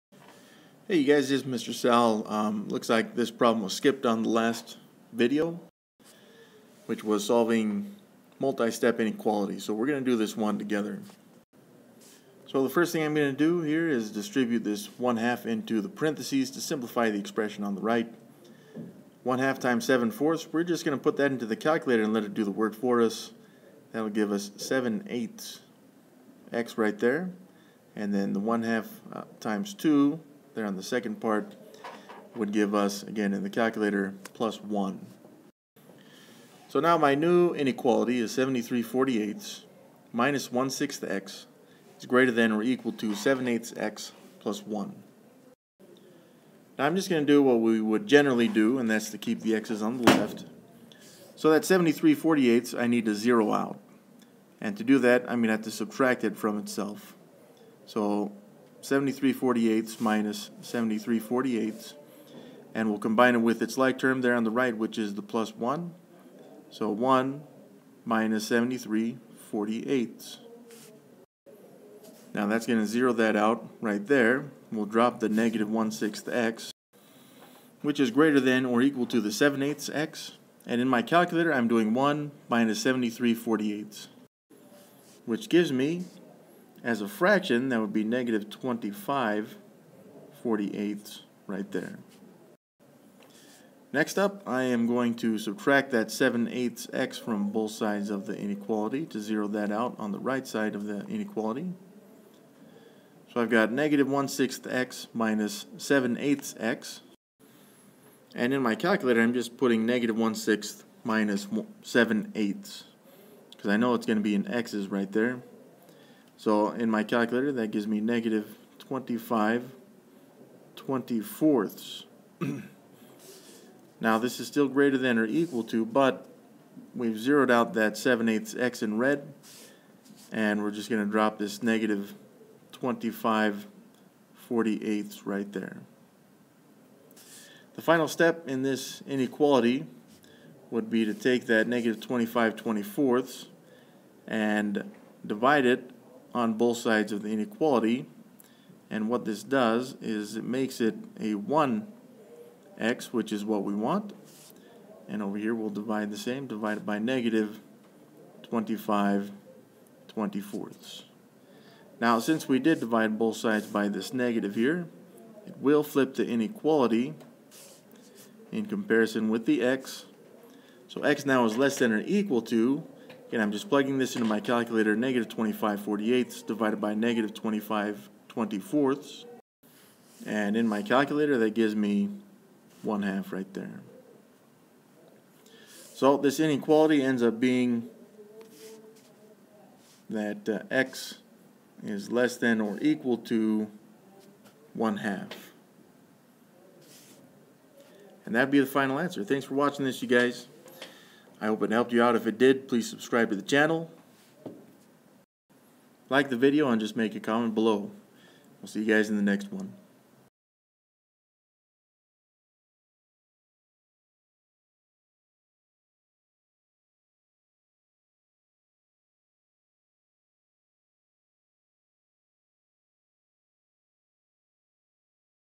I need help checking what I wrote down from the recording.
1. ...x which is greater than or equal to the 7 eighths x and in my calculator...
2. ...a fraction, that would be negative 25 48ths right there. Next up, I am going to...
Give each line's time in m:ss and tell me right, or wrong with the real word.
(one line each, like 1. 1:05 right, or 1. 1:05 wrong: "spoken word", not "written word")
1. 1:16 right
2. 1:27 right.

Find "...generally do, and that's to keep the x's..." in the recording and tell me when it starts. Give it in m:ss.
0:48.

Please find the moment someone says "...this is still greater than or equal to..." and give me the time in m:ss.
2:04.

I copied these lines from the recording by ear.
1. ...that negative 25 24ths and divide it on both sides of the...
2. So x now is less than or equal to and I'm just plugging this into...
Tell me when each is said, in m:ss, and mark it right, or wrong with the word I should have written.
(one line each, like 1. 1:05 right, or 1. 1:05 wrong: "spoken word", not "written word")
1. 2:21 right
2. 2:50 right.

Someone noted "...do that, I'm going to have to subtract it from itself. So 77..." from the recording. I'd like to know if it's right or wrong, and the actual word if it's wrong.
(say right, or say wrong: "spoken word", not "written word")
wrong: "73", not "77".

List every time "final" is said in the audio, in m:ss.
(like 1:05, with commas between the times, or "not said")
2:17, 3:18.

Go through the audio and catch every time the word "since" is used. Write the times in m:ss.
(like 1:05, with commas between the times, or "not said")
2:42.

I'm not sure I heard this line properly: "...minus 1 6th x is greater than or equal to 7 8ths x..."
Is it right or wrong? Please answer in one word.
right.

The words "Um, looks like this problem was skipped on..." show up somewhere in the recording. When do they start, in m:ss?
0:02.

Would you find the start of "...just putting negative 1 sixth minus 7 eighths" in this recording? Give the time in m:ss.
1:49.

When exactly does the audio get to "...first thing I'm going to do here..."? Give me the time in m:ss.
0:12.